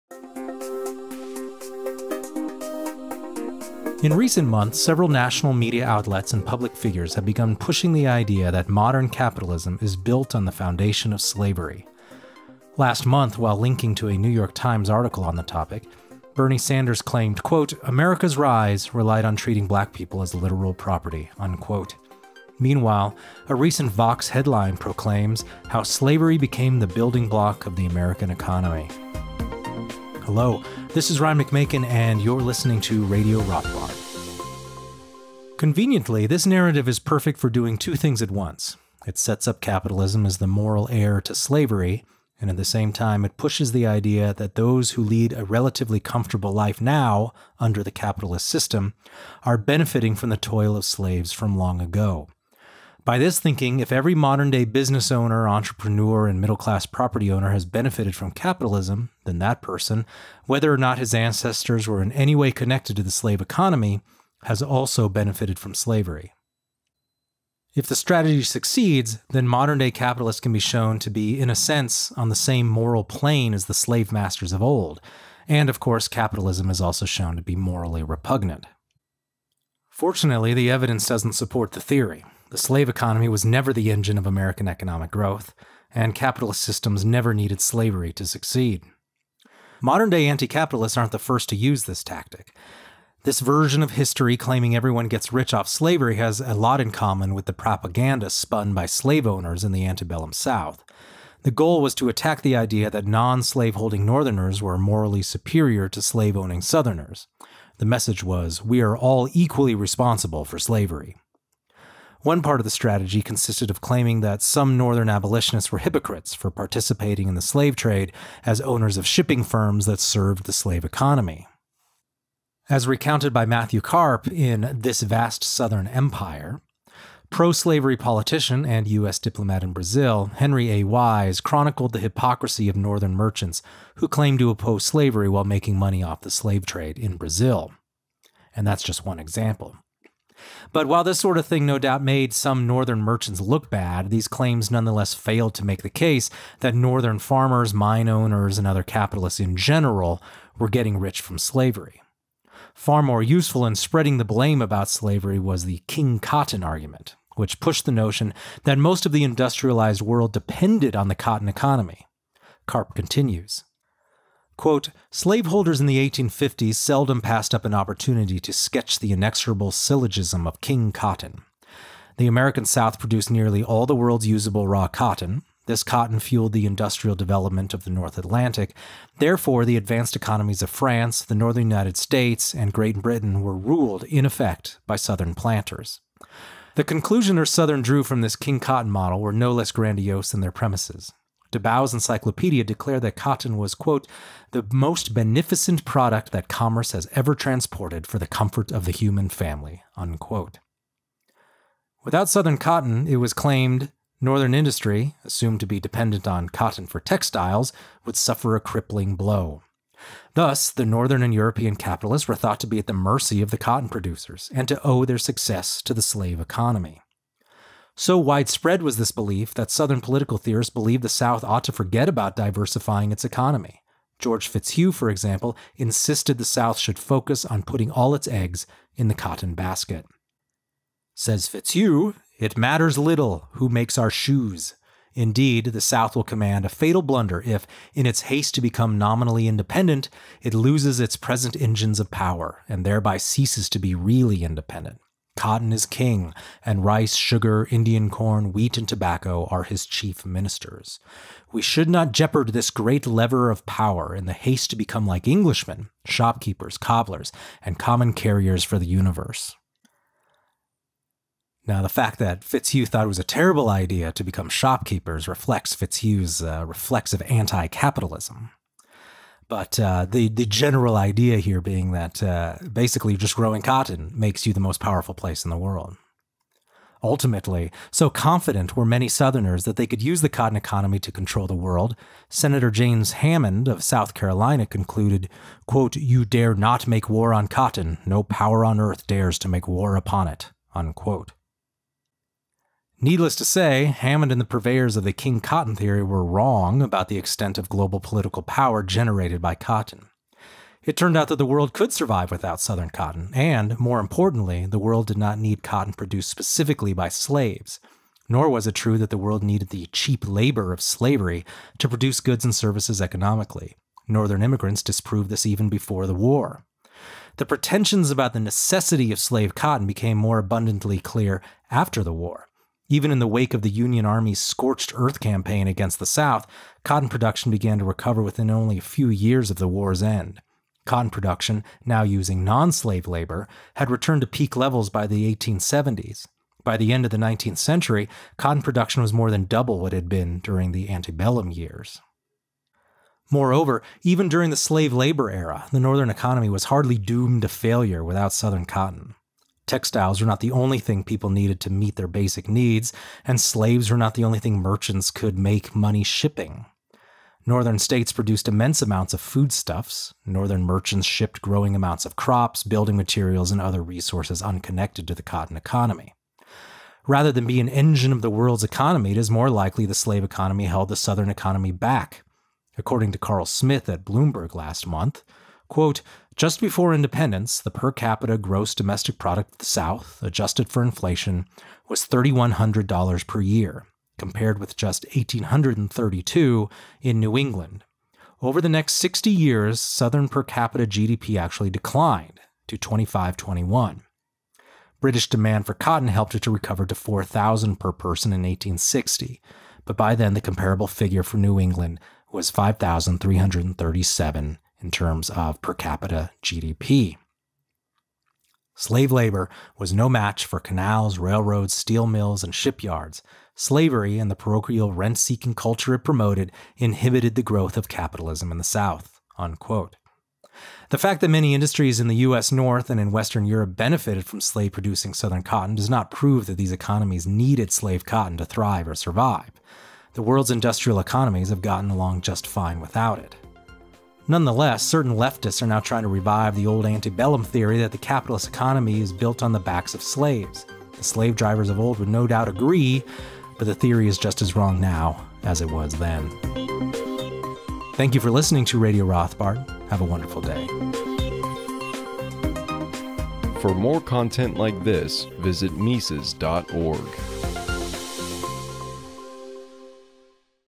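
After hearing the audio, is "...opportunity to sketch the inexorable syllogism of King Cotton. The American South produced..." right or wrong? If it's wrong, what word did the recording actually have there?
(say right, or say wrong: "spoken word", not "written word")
right.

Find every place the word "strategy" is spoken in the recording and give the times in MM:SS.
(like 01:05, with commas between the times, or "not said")
01:07, 01:52.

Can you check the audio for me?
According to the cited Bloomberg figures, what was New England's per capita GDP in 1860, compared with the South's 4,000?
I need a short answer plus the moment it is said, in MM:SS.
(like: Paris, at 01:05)
5,337, at 06:42.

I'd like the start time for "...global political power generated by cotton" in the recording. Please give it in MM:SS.
04:57.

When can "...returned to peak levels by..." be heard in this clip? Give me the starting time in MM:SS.
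05:33.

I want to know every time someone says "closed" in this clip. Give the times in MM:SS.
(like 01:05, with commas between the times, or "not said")
not said.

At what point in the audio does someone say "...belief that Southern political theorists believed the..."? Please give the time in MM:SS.
03:39.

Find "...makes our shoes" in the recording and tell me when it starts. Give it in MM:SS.
03:53.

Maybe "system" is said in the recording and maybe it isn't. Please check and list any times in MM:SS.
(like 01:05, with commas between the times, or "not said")
00:48, 01:26.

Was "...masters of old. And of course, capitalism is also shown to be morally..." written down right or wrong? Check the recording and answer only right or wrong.
right.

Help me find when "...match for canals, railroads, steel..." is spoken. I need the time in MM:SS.
06:50.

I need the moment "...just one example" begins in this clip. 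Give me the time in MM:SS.
02:18.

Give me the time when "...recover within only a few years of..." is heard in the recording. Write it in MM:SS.
05:27.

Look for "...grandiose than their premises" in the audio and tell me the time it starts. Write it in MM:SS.
03:09.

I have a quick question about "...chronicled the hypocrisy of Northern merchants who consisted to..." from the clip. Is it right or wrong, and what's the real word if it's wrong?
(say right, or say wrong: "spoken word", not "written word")
wrong: "claimed", not "consisted".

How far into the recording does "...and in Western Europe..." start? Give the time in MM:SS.
07:02.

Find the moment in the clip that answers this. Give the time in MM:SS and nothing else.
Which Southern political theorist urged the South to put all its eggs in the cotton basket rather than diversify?
03:44.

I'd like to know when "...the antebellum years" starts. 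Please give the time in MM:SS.
05:40.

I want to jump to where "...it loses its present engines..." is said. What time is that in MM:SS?
04:00.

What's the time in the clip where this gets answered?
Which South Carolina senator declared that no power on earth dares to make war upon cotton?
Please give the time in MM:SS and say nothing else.
04:42.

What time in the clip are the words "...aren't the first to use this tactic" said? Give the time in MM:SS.
01:30.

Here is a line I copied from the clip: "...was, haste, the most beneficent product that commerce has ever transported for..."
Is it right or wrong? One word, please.
wrong.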